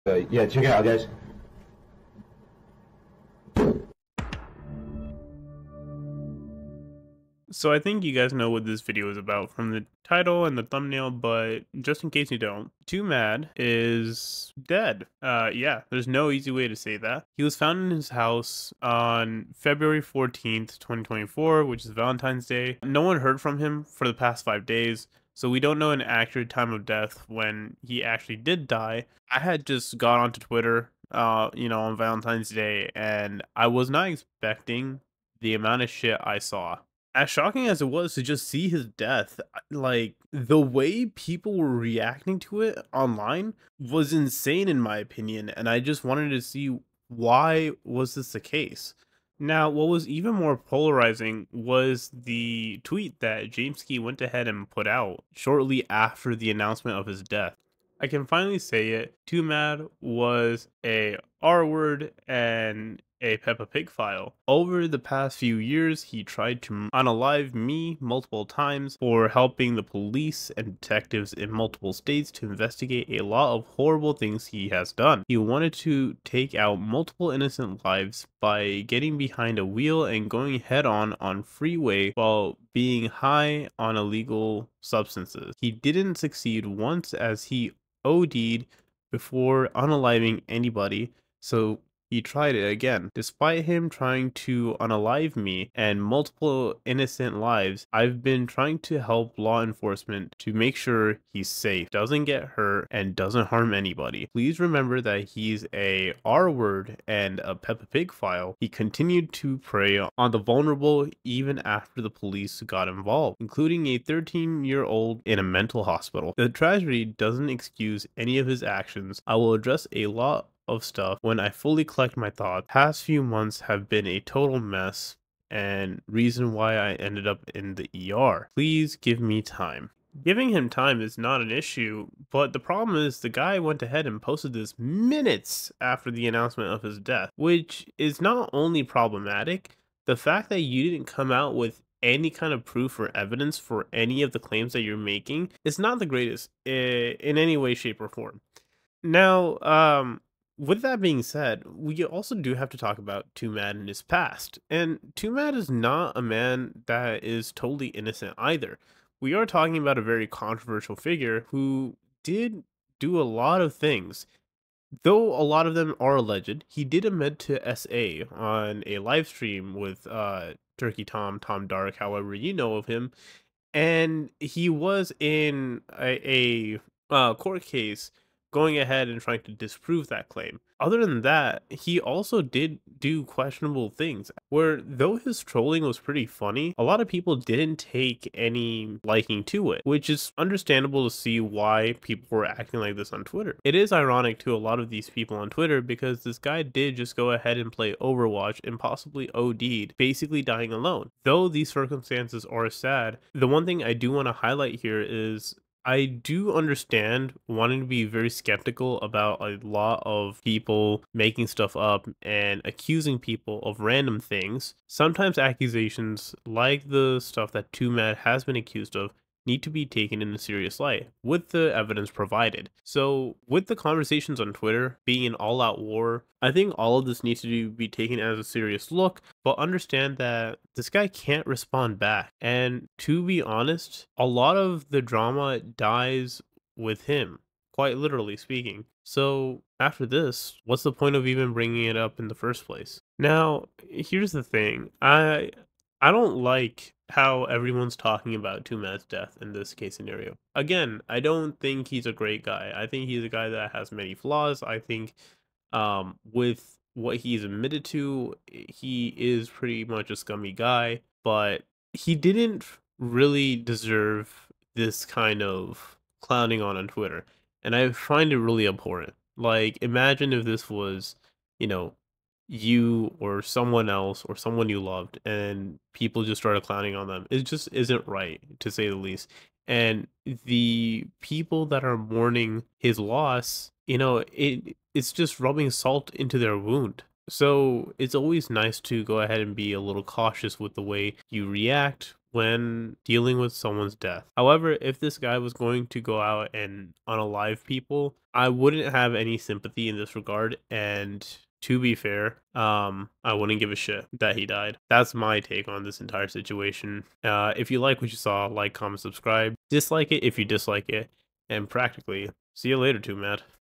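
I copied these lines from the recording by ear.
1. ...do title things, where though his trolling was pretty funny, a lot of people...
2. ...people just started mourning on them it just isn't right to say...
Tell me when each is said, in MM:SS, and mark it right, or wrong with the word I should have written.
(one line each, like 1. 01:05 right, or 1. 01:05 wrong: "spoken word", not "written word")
1. 03:02 wrong: "questionable", not "title"
2. 04:35 wrong: "clowning", not "mourning".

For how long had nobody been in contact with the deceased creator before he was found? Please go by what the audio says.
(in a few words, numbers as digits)
5 days.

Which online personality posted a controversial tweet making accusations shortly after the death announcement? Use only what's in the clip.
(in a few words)
Jameskii.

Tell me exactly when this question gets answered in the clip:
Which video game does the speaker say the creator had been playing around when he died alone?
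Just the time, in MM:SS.
03:18.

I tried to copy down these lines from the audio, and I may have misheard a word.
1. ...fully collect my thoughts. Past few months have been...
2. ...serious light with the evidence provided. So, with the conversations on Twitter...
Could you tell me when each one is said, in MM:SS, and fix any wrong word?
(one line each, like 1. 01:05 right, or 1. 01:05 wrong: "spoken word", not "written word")
1. 02:01 right
2. 03:40 right.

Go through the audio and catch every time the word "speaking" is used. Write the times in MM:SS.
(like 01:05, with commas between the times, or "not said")
03:58.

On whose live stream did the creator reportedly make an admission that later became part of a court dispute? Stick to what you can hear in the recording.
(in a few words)
Turkey Tom.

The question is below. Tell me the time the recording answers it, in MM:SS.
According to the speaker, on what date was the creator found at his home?
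00:19.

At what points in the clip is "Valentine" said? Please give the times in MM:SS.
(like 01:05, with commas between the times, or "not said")
00:21, 00:31.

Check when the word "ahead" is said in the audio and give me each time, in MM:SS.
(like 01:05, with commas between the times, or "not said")
00:54, 02:13, 02:58, 03:17, 04:49.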